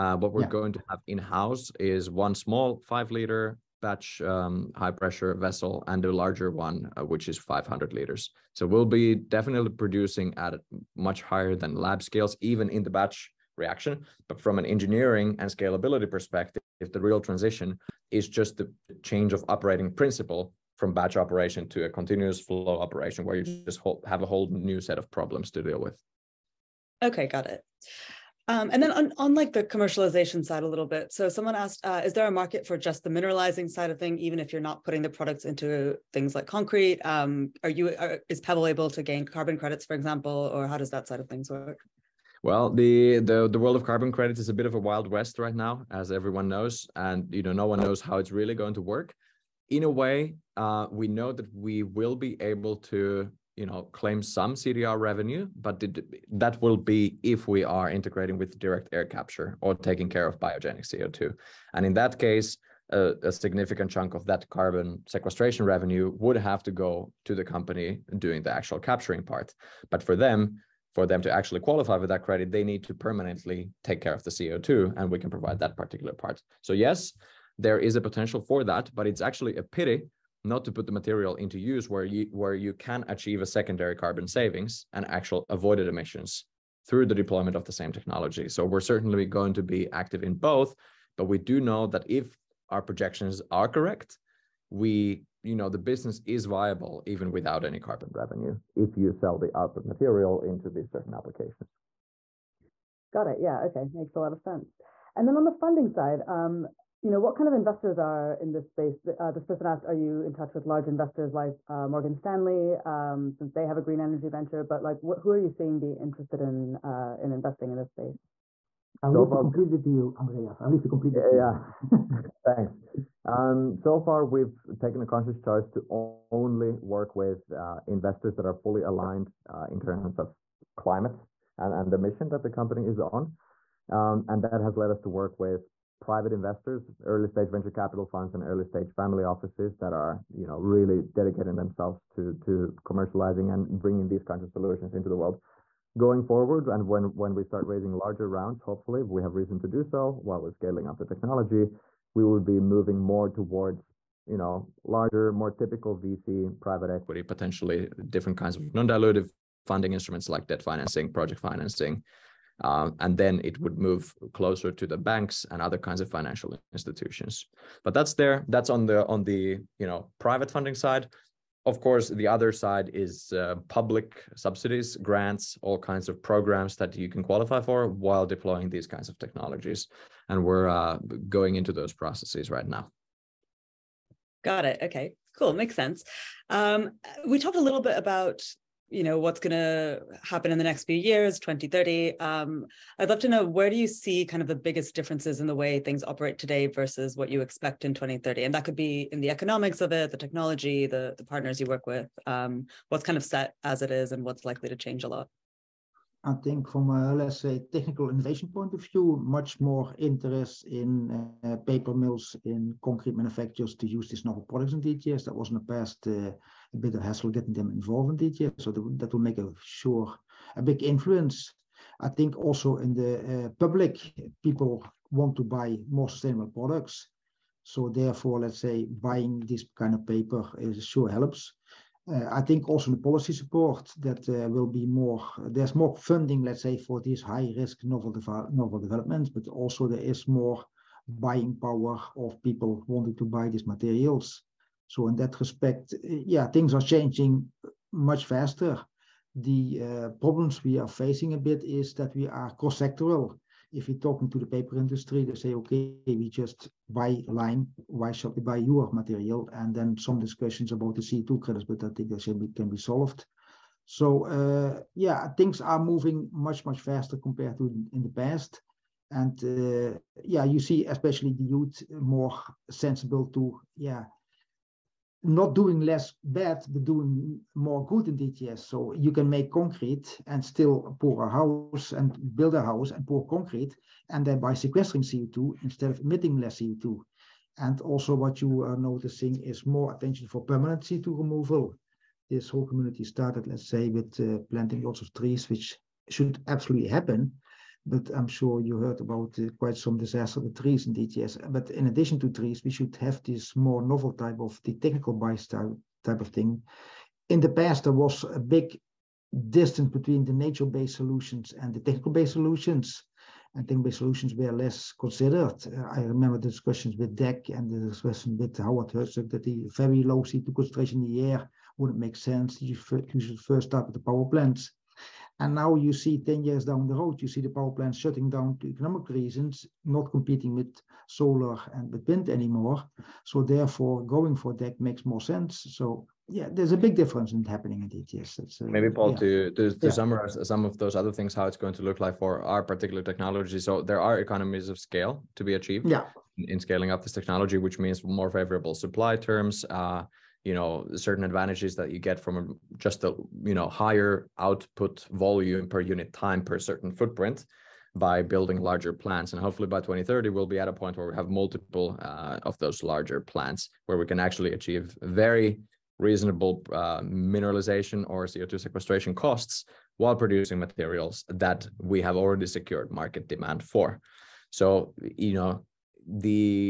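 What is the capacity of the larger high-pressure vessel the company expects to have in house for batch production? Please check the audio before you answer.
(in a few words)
500 liters.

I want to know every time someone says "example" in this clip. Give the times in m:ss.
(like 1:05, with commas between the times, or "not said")
0:39.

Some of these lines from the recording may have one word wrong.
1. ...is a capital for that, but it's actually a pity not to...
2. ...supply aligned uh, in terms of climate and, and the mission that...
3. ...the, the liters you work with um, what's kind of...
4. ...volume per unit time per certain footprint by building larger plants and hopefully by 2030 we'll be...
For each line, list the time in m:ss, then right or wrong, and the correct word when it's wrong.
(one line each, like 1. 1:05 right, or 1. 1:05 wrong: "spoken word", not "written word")
1. 1:17 wrong: "potential", not "capital"
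2. 2:08 wrong: "fully", not "supply"
3. 3:20 wrong: "partners", not "liters"
4. 5:55 right.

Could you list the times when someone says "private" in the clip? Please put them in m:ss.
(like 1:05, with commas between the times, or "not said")
2:15, 2:36, 2:50.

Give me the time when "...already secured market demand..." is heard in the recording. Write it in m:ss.
6:12.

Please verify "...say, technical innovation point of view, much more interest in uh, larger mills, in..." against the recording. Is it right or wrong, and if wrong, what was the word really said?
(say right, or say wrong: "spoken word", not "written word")
wrong: "paper", not "larger".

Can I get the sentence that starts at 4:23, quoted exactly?
So uh, yeah, things are moving much, much faster compared to in the past.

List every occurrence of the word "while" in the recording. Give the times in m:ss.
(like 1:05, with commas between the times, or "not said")
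2:30, 2:57, 6:09.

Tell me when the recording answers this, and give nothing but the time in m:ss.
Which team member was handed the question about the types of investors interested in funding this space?
2:00.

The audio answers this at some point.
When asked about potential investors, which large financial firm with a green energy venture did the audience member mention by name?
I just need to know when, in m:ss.
1:51.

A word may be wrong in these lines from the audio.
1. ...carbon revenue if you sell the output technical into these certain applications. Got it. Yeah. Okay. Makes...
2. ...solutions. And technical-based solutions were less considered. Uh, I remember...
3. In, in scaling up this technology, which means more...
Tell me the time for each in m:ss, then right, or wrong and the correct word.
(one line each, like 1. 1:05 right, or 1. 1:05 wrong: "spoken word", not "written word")
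1. 1:37 wrong: "material", not "technical"
2. 5:12 right
3. 5:46 right.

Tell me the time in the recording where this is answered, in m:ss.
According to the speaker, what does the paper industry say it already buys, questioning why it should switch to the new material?
4:17.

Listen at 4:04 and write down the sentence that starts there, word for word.
So in that respect, uh, yeah, things are changing much faster.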